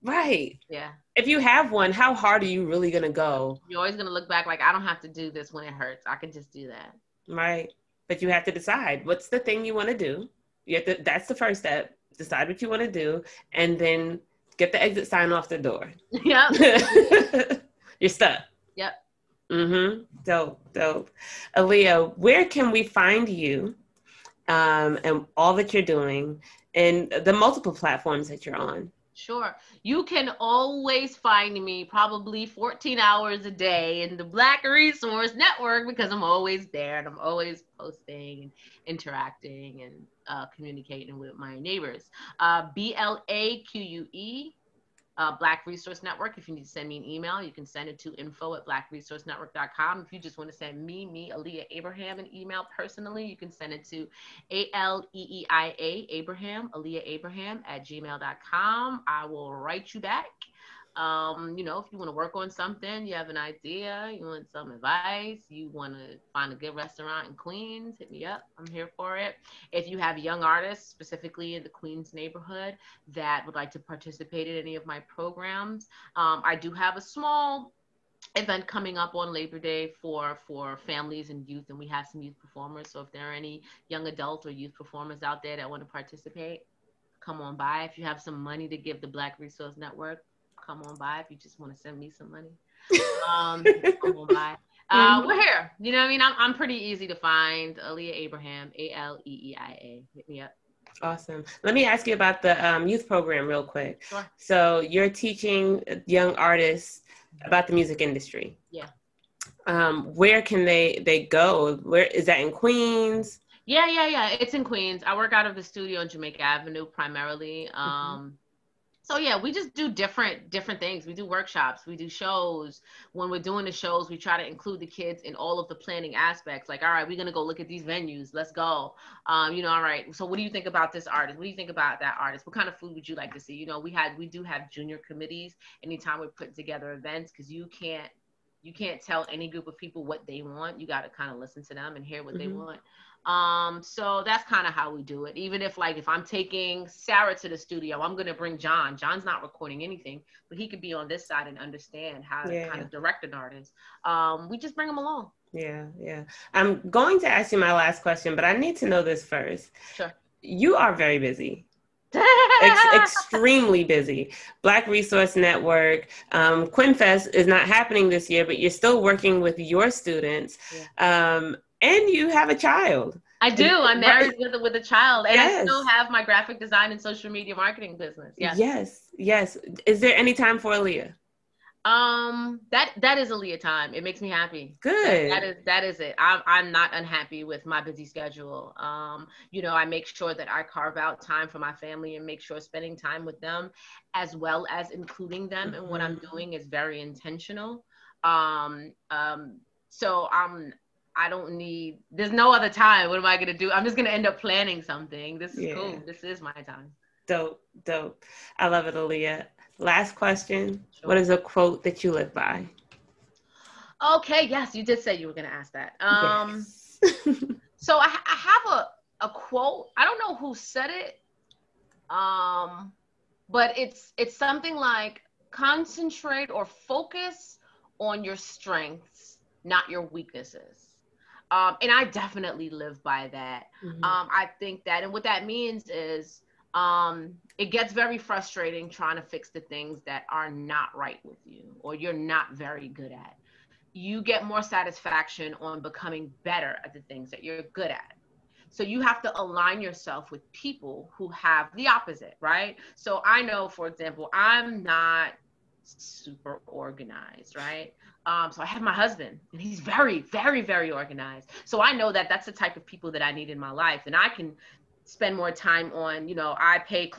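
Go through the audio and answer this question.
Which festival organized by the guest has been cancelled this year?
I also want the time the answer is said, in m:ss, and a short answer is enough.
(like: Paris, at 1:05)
QuinFest, at 2:46.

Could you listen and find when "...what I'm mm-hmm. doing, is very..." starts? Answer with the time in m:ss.
3:15.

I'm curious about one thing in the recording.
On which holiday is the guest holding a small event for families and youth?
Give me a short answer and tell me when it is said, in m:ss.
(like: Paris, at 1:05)
Labor Day, at 1:19.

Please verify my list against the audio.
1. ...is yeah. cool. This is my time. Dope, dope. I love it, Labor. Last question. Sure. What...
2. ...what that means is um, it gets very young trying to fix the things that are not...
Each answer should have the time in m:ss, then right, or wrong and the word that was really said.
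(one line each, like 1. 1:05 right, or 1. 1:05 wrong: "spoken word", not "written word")
1. 3:25 wrong: "Aleeia", not "Labor"
2. 3:55 wrong: "frustrating", not "young".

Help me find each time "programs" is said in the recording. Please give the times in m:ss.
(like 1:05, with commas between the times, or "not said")
1:14, 1:43.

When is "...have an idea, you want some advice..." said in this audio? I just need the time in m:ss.
1:03.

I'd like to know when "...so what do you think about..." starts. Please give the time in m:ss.
2:10.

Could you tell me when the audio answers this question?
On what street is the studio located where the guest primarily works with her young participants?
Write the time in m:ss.
1:56.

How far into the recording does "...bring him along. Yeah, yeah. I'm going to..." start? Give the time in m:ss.
2:34.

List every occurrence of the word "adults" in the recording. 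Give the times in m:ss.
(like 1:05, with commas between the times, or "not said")
1:24.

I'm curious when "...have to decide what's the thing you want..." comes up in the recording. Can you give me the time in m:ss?
0:08.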